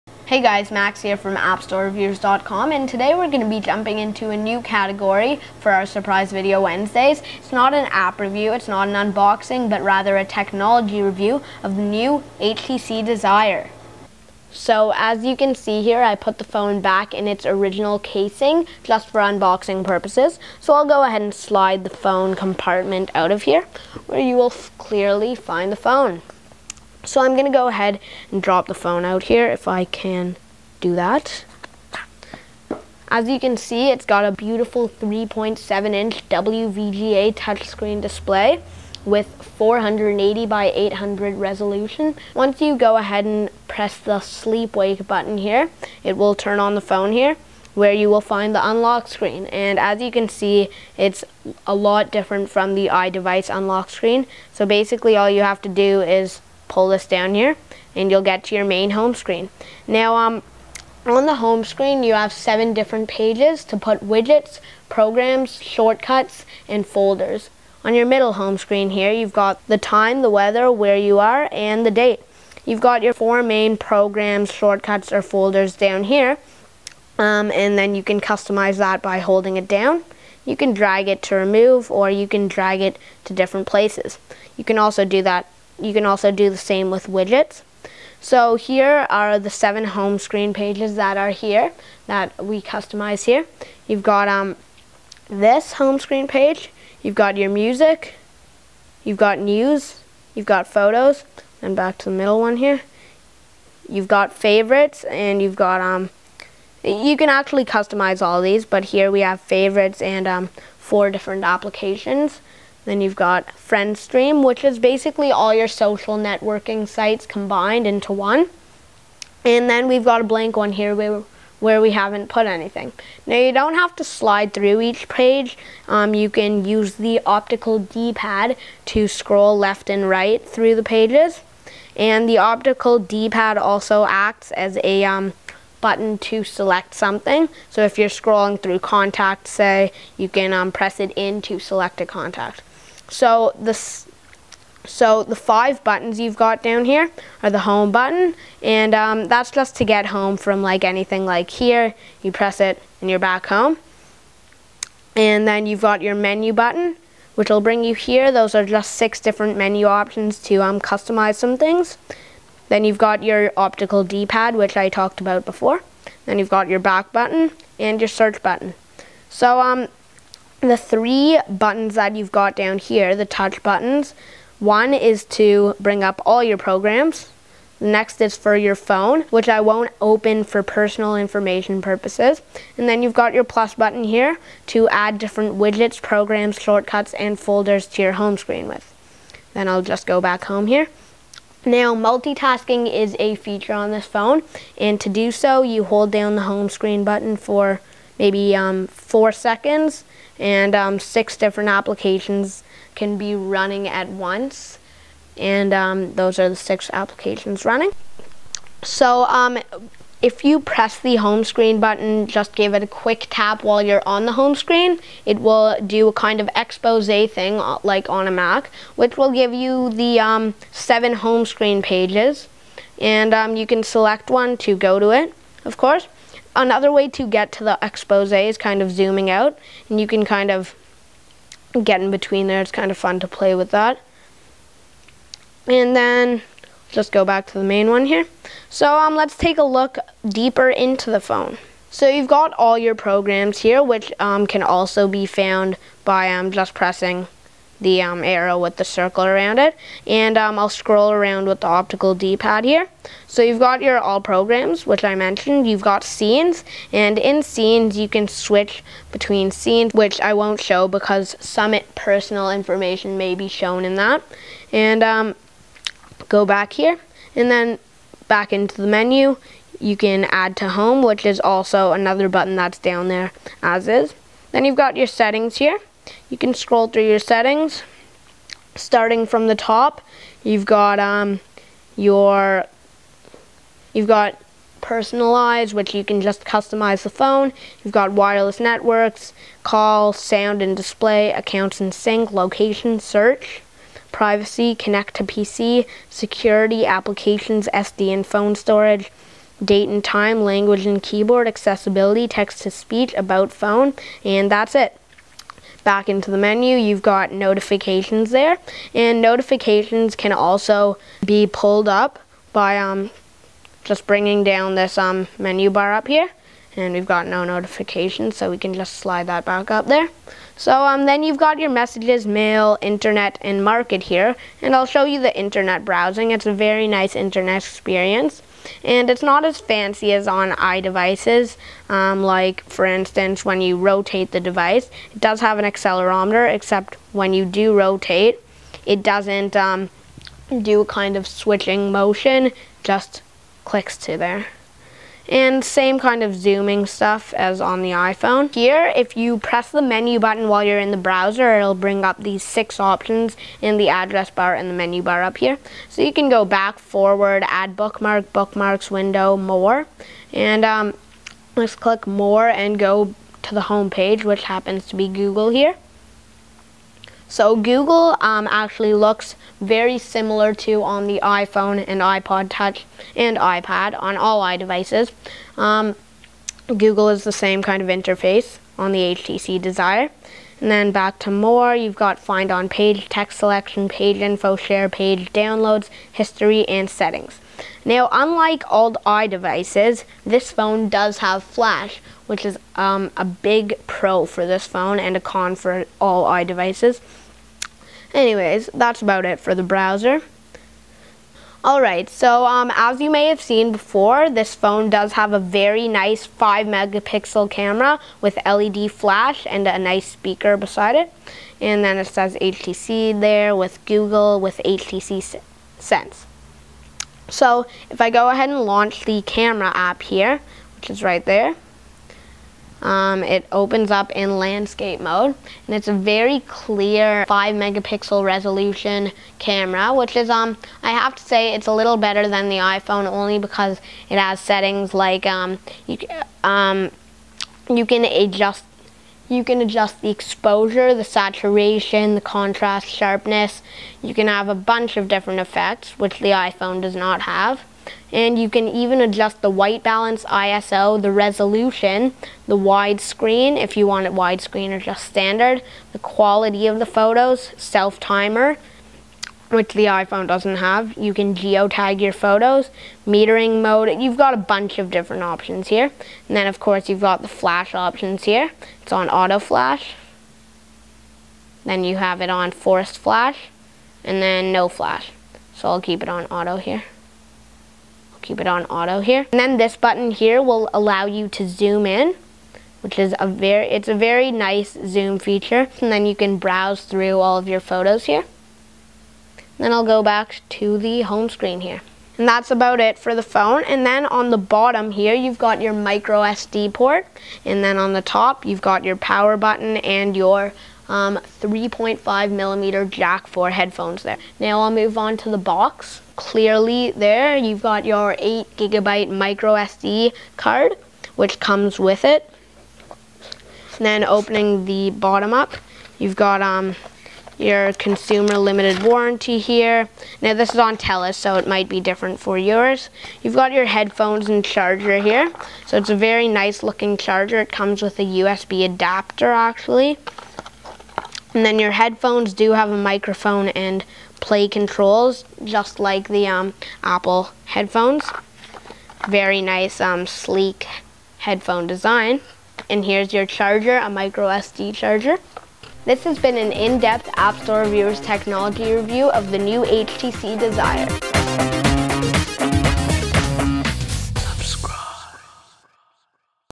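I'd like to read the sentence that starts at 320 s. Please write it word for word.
So um, then you've got your messages, mail, internet, and market here.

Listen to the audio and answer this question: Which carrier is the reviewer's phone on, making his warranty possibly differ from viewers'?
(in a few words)
TELUS.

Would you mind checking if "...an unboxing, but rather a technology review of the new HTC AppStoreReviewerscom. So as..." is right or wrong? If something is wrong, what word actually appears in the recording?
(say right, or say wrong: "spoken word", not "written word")
wrong: "Desire", not "AppStoreReviewerscom".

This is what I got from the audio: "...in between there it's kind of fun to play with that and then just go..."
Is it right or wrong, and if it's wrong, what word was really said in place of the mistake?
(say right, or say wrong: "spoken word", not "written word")
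right.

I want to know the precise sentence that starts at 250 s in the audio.
And um, I'll scroll around with the optical D-pad here.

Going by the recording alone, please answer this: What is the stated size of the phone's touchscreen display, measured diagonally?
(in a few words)
3.7 inch.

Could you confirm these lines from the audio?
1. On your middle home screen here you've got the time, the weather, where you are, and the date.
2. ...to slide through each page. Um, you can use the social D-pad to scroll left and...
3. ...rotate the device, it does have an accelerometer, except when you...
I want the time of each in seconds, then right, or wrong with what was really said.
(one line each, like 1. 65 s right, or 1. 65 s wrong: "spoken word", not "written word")
1. 67 s right
2. 123 s wrong: "optical", not "social"
3. 333 s right.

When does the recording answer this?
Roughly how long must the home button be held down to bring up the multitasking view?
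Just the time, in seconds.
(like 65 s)
198 s.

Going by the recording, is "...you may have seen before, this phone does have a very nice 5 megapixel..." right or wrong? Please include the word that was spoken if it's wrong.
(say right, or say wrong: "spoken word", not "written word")
right.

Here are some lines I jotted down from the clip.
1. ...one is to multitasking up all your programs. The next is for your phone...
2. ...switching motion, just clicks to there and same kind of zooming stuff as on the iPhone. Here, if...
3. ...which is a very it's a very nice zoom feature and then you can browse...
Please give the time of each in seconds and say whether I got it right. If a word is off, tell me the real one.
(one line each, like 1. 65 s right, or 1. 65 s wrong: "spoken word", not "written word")
1. 174 s wrong: "bring", not "multitasking"
2. 341 s right
3. 482 s right.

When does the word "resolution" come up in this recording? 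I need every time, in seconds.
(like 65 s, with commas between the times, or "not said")
41 s, 428 s, 451 s.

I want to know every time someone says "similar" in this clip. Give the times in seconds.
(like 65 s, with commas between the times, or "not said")
369 s.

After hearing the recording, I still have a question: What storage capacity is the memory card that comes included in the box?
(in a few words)
8 gigabyte.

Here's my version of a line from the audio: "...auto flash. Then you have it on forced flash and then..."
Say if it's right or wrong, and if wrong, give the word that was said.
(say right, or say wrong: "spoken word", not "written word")
right.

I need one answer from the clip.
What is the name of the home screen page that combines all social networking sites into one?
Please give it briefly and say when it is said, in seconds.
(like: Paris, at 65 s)
FriendStream, at 113 s.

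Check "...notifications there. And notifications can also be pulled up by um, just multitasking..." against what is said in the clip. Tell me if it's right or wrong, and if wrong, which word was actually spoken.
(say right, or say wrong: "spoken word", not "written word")
wrong: "bringing", not "multitasking".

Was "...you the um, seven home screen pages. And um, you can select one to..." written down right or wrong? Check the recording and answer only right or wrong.
right.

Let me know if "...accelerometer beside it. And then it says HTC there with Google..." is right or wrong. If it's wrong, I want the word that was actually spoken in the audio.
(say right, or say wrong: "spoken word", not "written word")
wrong: "speaker", not "accelerometer".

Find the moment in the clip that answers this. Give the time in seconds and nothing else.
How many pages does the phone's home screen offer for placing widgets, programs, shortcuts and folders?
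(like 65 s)
62 s.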